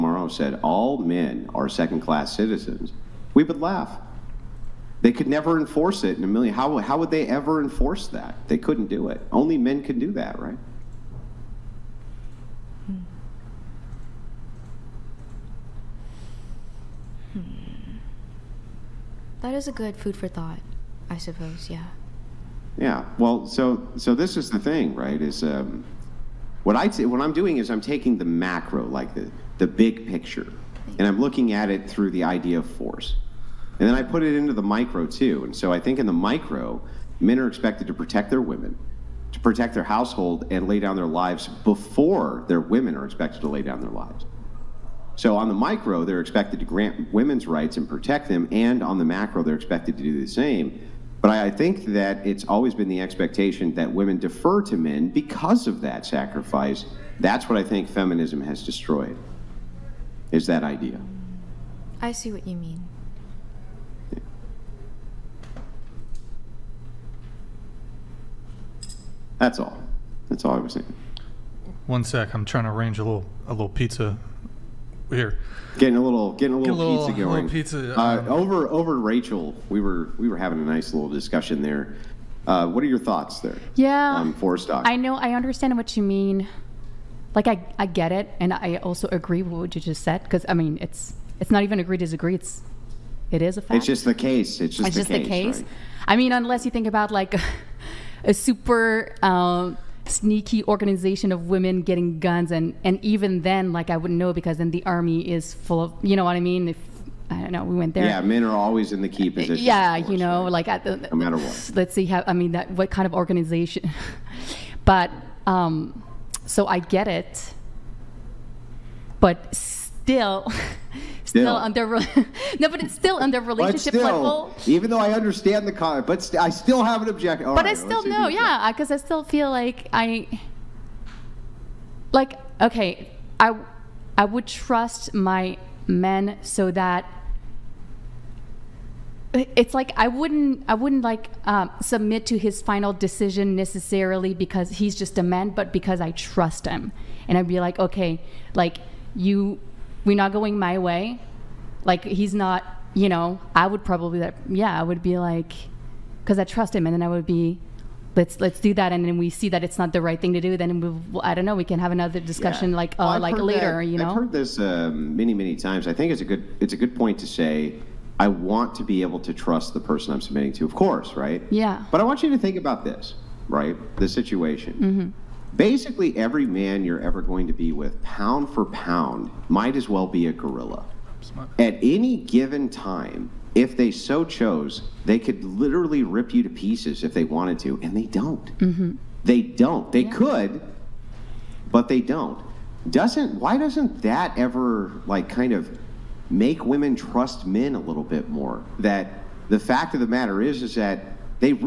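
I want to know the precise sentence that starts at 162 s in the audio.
like uh, well, like later, that, you know.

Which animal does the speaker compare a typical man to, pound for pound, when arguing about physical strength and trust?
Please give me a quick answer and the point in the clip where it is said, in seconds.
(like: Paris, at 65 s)
gorilla, at 180 s.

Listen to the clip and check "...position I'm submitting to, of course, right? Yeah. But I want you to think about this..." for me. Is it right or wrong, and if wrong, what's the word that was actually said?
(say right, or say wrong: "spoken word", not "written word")
wrong: "person", not "position".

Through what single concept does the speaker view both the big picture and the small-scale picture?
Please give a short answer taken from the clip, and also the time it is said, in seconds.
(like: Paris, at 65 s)
force, at 32 s.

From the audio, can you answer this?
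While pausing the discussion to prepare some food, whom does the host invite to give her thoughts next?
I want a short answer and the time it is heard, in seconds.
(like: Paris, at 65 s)
Rachel, at 78 s.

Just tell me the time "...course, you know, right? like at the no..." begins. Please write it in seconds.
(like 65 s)
110 s.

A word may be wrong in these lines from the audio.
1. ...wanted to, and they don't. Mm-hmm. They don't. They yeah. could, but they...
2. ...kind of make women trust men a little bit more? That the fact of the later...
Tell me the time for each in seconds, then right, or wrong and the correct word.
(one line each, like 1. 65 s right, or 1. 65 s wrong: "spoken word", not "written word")
1. 187 s right
2. 195 s wrong: "matter", not "later".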